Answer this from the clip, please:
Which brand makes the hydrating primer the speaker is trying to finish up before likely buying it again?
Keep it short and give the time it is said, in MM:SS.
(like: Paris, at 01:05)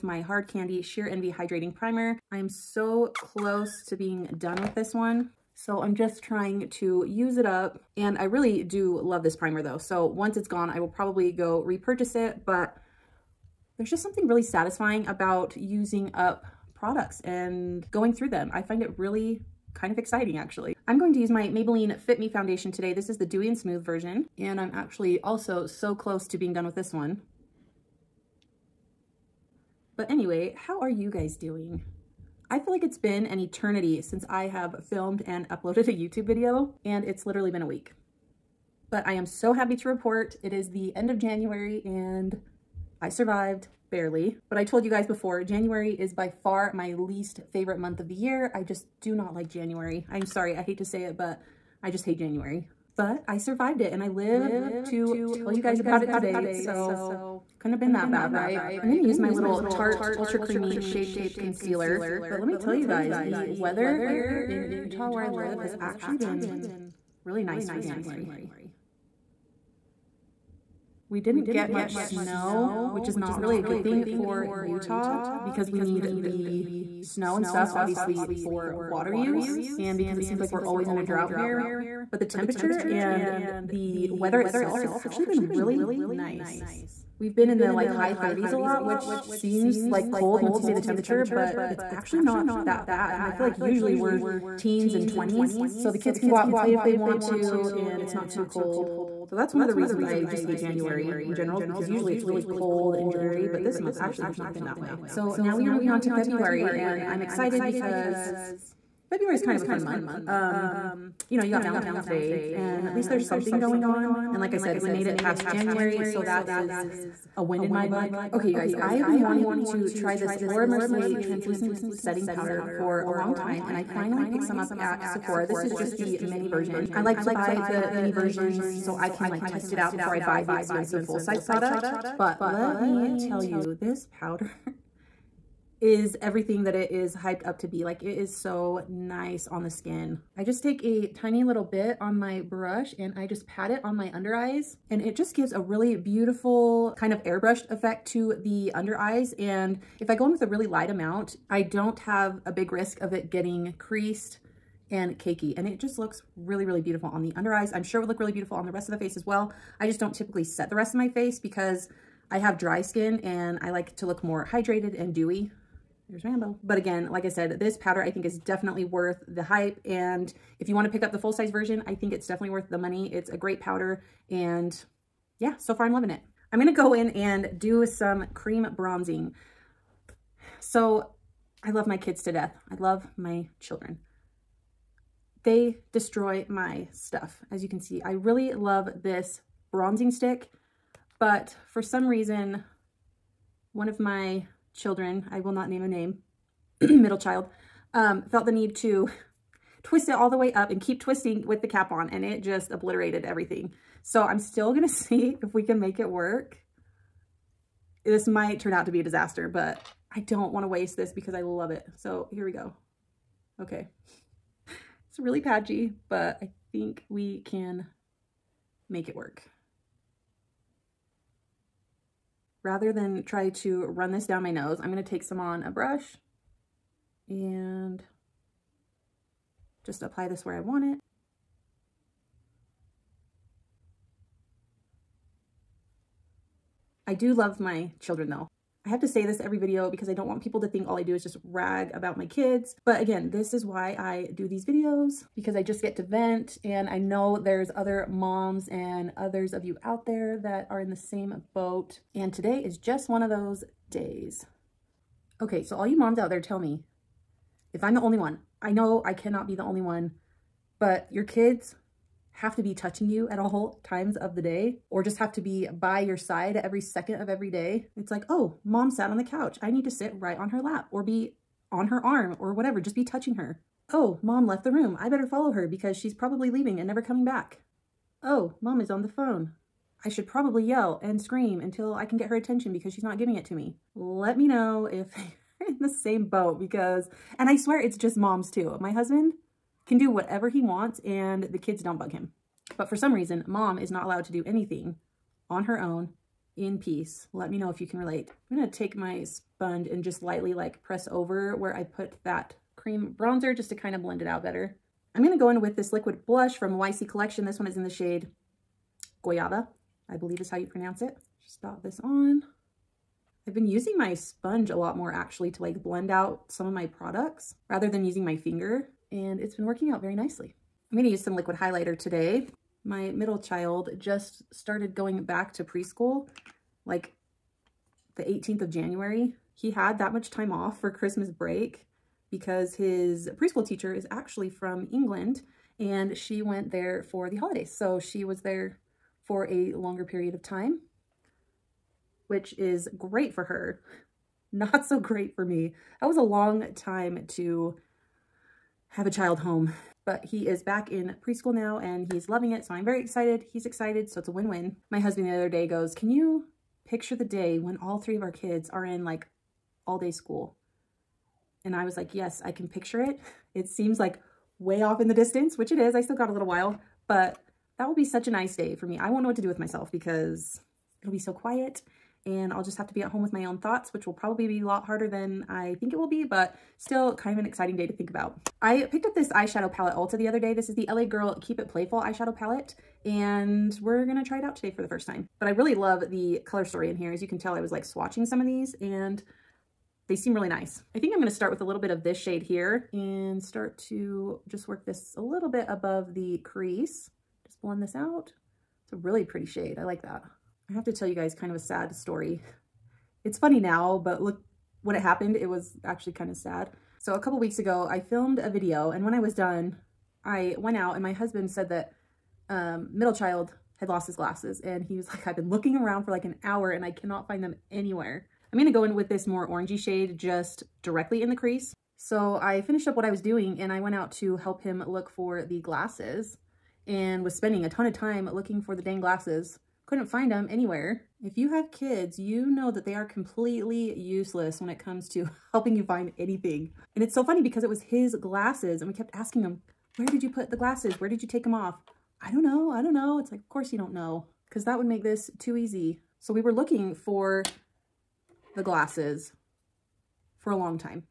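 Hard Candy, at 00:00.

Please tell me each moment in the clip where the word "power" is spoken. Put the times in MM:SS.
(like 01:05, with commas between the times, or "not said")
not said.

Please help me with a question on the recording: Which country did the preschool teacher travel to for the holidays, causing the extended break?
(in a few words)
England.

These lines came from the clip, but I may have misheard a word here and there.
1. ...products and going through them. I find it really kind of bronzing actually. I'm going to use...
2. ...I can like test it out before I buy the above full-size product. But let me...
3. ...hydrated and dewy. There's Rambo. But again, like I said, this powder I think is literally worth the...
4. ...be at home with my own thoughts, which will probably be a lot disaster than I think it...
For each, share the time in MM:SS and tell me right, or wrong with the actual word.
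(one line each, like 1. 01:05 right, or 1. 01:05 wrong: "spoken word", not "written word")
1. 00:16 wrong: "exciting", not "bronzing"
2. 02:08 wrong: "expensive", not "above"
3. 02:44 wrong: "definitely", not "literally"
4. 06:12 wrong: "harder", not "disaster".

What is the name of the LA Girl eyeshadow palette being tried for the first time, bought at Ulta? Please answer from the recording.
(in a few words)
Keep It Playful.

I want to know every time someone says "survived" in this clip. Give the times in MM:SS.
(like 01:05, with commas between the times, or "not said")
00:43, 00:53.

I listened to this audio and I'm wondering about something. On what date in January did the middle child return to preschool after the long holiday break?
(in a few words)
the 18th.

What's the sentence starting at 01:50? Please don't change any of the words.
Um, you know, you got Valentine's Day and at least there's something going on.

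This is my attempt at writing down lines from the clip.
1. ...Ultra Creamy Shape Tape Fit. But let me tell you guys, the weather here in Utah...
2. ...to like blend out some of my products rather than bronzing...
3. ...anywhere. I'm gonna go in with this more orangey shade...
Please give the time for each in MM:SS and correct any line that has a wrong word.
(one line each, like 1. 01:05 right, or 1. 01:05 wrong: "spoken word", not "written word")
1. 01:00 wrong: "Concealer", not "Fit"
2. 05:15 wrong: "using", not "bronzing"
3. 06:57 right.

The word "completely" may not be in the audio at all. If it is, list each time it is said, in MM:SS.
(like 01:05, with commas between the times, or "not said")
07:13.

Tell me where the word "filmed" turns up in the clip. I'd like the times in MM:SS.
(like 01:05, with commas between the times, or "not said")
00:34, 06:47.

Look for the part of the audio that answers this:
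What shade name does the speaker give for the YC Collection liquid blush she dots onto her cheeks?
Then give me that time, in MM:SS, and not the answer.
05:09.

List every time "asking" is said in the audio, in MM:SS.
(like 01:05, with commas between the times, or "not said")
07:19.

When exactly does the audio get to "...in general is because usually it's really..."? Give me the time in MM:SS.
01:41.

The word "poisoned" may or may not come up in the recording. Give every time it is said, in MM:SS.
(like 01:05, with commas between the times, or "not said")
not said.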